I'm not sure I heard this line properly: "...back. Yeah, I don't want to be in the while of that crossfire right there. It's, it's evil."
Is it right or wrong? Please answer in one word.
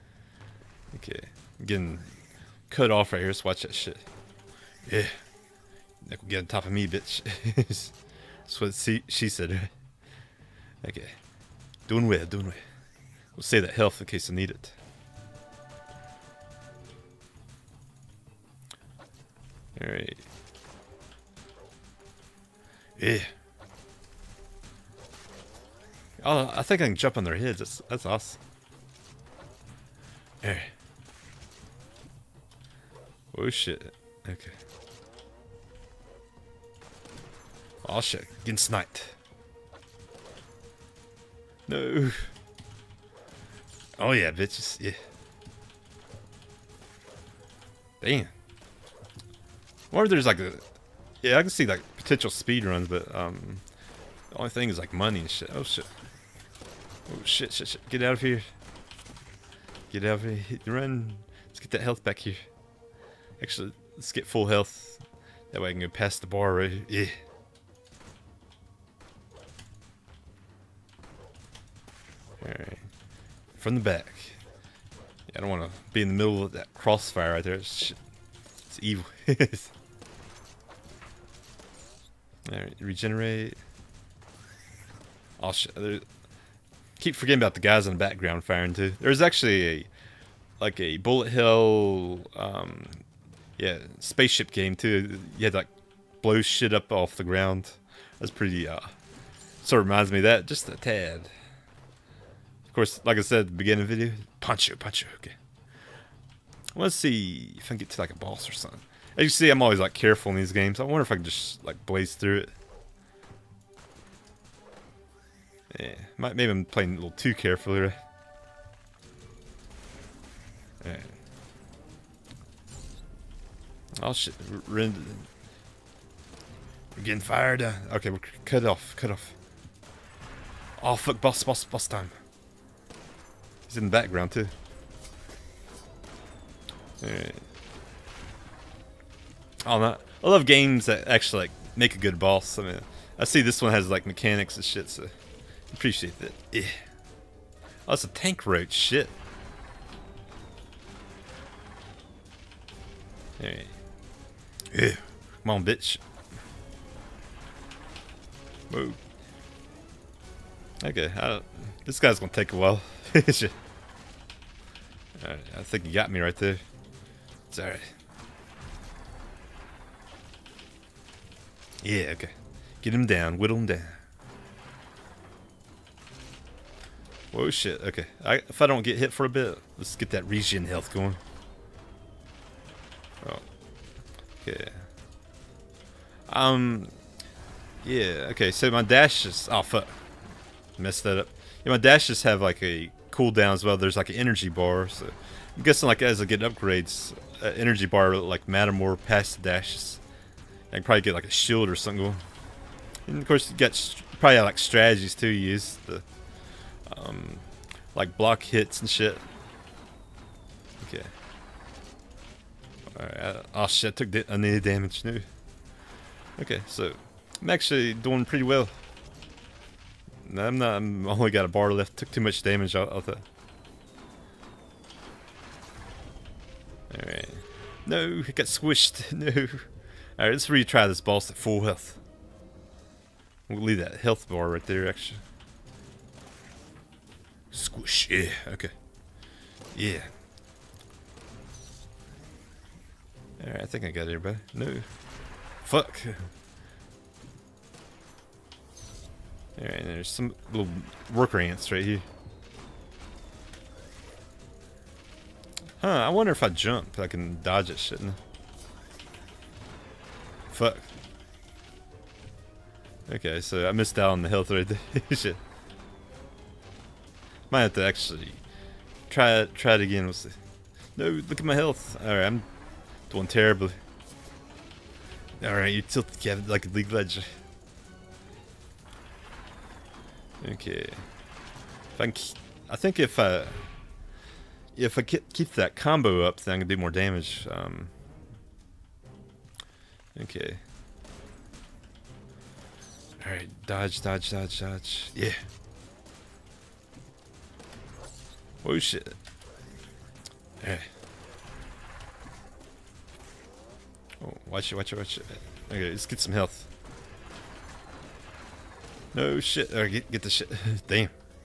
wrong.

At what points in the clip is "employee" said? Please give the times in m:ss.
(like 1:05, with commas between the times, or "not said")
not said.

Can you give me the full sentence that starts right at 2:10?
Oh fuck, boss, boss, boss time.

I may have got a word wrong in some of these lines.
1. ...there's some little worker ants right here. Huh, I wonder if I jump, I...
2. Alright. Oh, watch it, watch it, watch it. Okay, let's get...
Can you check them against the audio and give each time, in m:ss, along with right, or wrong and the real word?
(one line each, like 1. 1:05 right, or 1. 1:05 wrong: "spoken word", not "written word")
1. 4:09 right
2. 5:00 right.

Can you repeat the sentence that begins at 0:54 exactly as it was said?
The only thing is like money and shit.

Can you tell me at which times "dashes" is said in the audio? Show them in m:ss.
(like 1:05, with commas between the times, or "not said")
3:08, 3:19.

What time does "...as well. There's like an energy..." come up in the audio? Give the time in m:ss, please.
3:13.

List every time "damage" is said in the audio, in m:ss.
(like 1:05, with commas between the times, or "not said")
3:34, 3:42, 4:46.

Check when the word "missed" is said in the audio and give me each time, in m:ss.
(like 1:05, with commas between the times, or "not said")
4:23.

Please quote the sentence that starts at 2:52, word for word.
Get him down, whittle him down.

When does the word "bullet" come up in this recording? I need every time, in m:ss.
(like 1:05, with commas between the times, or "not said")
1:30.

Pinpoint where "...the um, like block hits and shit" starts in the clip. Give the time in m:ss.
3:25.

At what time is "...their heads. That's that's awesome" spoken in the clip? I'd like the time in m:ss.
0:27.